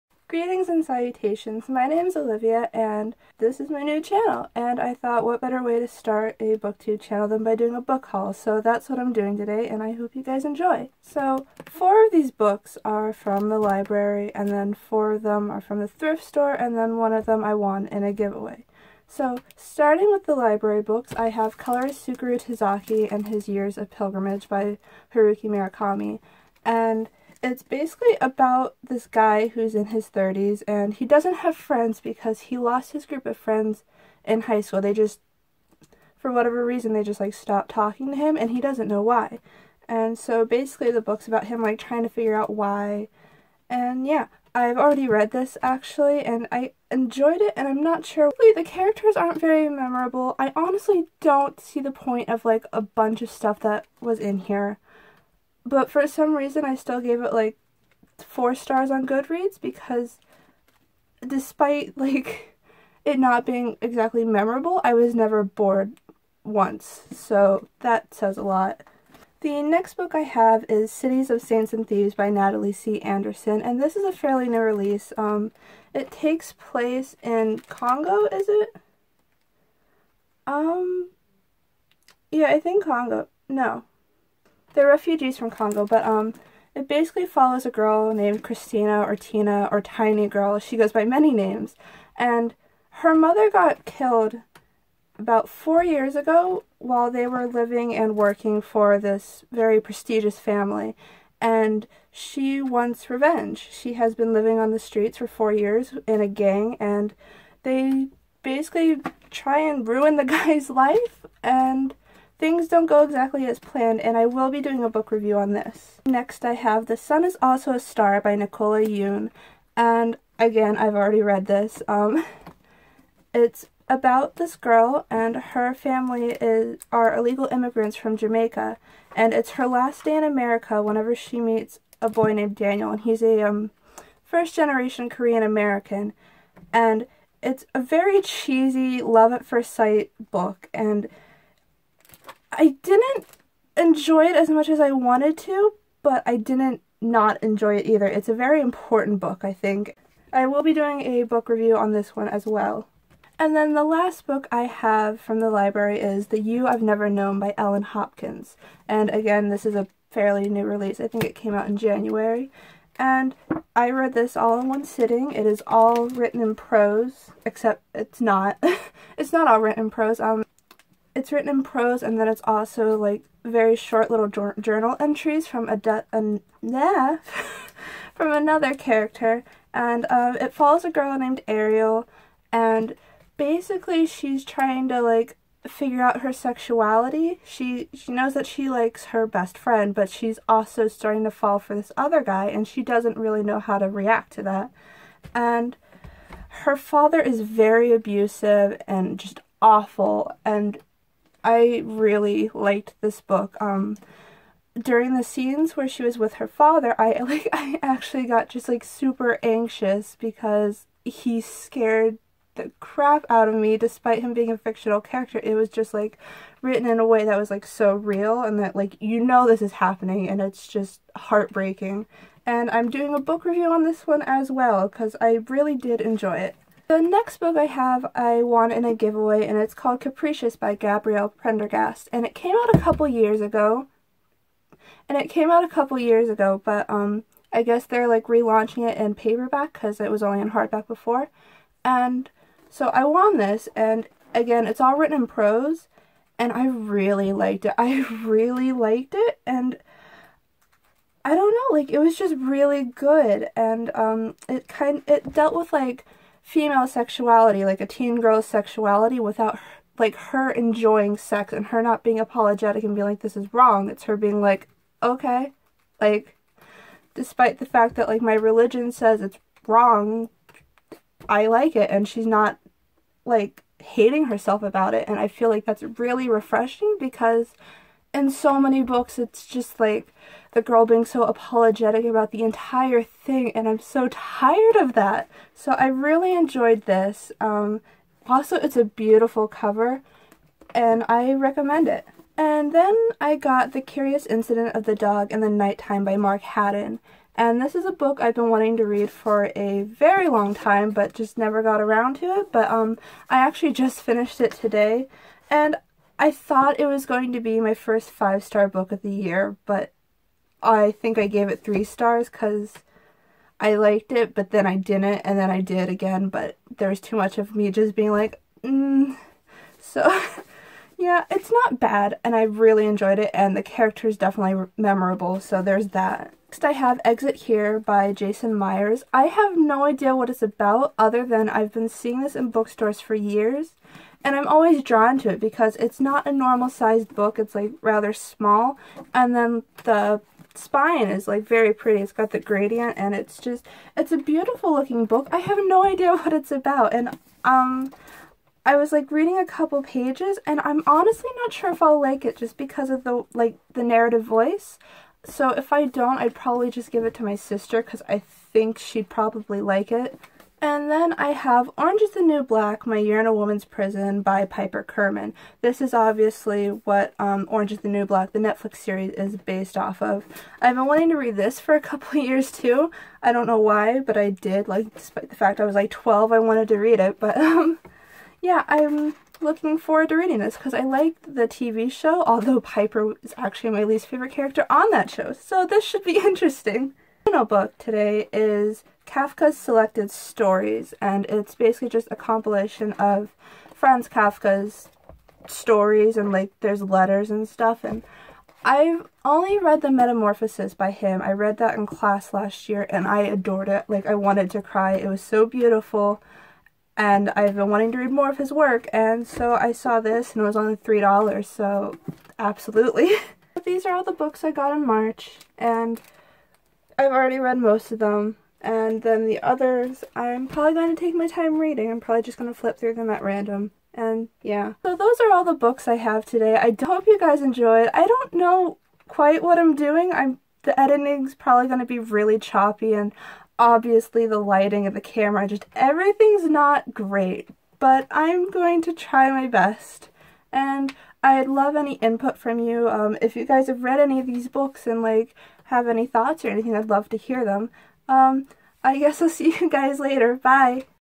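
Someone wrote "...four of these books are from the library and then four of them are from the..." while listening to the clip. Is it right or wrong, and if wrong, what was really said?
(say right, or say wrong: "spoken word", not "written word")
right.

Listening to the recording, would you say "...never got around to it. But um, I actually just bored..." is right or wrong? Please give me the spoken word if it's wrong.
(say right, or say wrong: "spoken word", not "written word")
wrong: "finished", not "bored".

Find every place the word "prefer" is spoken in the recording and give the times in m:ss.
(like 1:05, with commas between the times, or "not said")
not said.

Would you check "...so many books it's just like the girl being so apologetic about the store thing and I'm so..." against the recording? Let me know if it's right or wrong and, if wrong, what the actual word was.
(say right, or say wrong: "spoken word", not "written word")
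wrong: "entire", not "store".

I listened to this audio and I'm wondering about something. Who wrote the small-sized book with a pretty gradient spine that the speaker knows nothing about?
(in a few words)
Jason Myers.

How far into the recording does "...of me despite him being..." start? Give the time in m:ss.
3:33.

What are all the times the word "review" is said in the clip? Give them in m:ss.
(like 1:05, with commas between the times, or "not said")
1:55, 2:31, 3:43.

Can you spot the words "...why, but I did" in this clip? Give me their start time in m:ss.
6:13.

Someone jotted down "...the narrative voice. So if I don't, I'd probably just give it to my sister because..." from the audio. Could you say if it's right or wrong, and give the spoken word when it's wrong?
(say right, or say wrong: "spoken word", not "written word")
right.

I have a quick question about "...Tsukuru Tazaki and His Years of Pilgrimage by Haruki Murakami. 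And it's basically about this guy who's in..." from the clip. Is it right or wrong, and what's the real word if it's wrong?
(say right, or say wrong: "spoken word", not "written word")
right.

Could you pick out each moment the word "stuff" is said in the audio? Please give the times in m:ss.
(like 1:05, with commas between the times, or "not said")
0:53, 6:37.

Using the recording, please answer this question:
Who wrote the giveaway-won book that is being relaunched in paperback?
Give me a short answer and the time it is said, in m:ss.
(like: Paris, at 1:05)
Gabrielle Prendergast, at 3:50.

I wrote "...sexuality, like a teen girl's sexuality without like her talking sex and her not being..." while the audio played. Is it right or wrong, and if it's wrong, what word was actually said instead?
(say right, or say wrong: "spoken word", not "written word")
wrong: "enjoying", not "talking".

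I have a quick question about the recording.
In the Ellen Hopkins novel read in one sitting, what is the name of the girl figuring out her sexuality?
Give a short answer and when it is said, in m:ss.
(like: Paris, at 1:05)
Ariel, at 3:01.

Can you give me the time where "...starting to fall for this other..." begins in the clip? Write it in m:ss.
3:10.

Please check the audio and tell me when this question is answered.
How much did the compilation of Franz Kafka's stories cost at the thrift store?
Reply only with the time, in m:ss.
6:50.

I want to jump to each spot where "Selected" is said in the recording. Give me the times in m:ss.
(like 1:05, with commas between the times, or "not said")
6:29.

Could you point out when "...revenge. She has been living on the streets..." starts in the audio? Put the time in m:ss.
1:43.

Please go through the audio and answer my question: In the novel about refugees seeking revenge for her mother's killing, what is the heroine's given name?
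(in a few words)
Christina.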